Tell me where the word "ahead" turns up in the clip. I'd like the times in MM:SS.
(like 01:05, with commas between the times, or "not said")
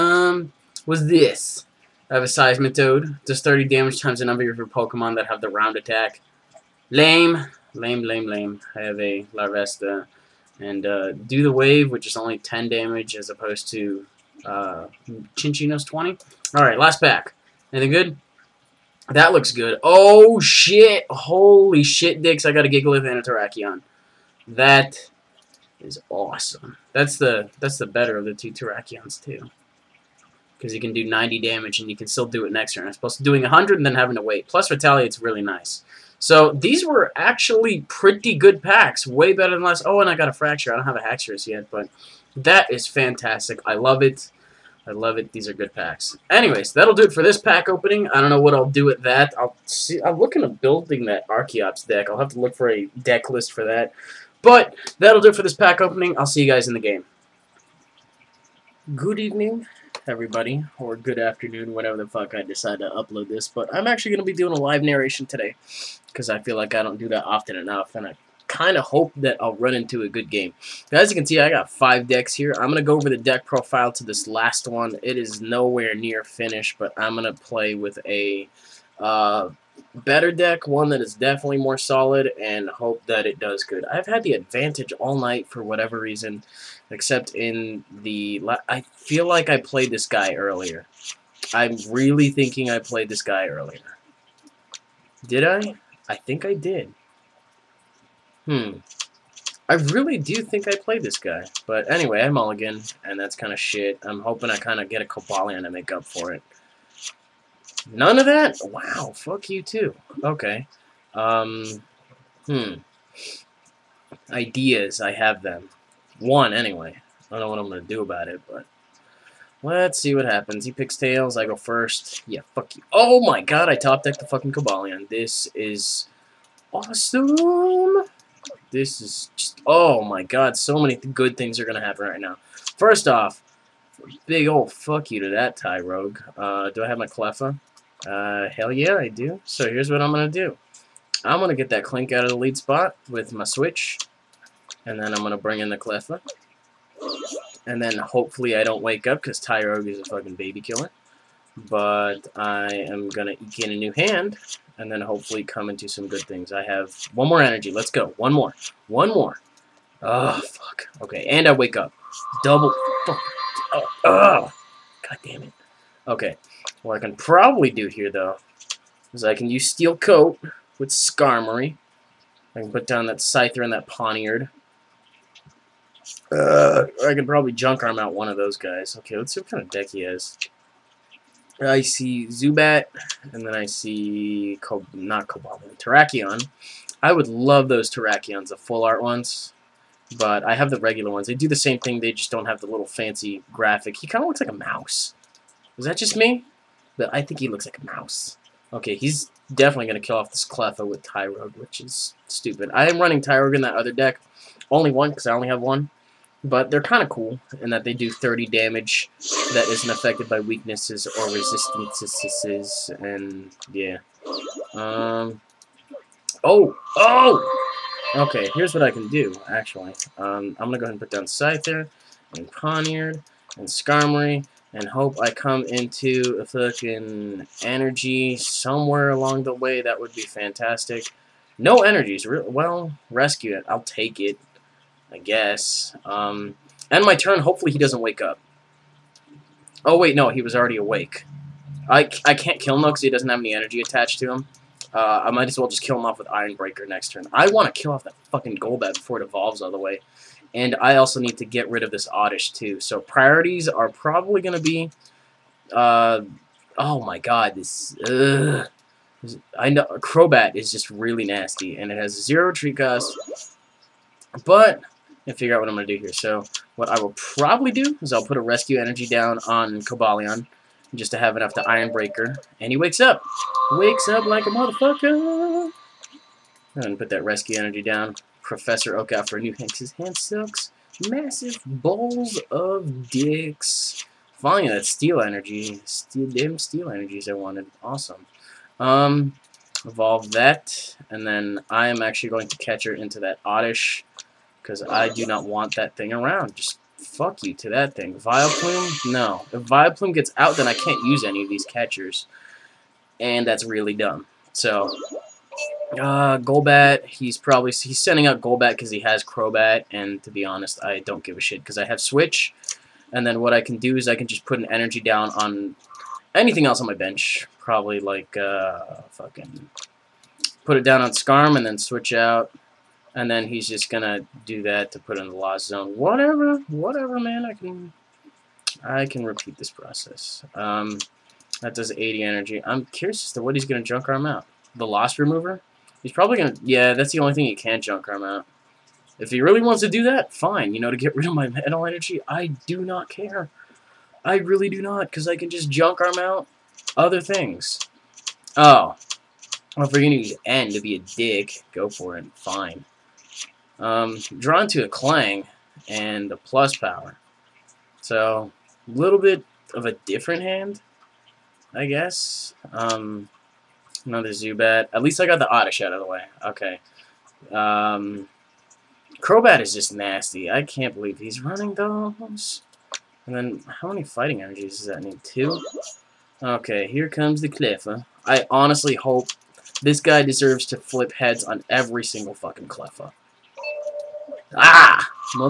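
03:40.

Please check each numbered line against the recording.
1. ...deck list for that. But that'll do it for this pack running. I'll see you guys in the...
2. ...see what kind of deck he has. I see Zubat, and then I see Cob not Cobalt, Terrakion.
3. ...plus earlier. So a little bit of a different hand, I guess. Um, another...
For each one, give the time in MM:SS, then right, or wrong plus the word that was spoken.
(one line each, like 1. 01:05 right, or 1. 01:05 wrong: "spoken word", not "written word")
1. 00:52 wrong: "opening", not "running"
2. 02:59 right
3. 05:56 wrong: "power", not "earlier".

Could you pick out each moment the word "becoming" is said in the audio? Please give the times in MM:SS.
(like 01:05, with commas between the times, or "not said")
not said.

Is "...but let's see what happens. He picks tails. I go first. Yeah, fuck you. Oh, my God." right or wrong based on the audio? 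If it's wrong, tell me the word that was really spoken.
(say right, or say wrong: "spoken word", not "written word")
right.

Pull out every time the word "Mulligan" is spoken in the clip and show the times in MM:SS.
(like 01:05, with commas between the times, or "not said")
01:42.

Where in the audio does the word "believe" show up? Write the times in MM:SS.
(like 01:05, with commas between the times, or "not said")
06:10.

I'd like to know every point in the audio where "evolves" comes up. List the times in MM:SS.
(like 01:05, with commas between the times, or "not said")
04:09, 04:49.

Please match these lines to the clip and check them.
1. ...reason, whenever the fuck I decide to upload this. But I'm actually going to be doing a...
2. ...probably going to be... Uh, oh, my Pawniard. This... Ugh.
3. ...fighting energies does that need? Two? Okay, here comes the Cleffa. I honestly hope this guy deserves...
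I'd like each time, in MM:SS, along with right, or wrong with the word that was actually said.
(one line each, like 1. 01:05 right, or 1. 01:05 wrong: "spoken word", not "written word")
1. 01:01 wrong: "afternoon", not "reason"
2. 04:13 wrong: "God", not "Pawniard"
3. 06:14 right.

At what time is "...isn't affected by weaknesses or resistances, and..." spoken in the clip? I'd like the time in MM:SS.
03:29.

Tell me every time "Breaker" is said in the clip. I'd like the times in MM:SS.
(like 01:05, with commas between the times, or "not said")
04:06, 04:31.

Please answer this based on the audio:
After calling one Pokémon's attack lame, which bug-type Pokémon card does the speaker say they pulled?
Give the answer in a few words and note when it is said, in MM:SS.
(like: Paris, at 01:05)
Larvesta, at 00:09.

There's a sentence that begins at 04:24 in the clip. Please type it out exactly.
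But and figure out what I'm going to do here.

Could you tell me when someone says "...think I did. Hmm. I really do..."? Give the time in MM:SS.
01:36.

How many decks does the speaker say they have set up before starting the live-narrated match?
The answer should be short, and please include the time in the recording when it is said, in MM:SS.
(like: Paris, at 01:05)
5, at 01:11.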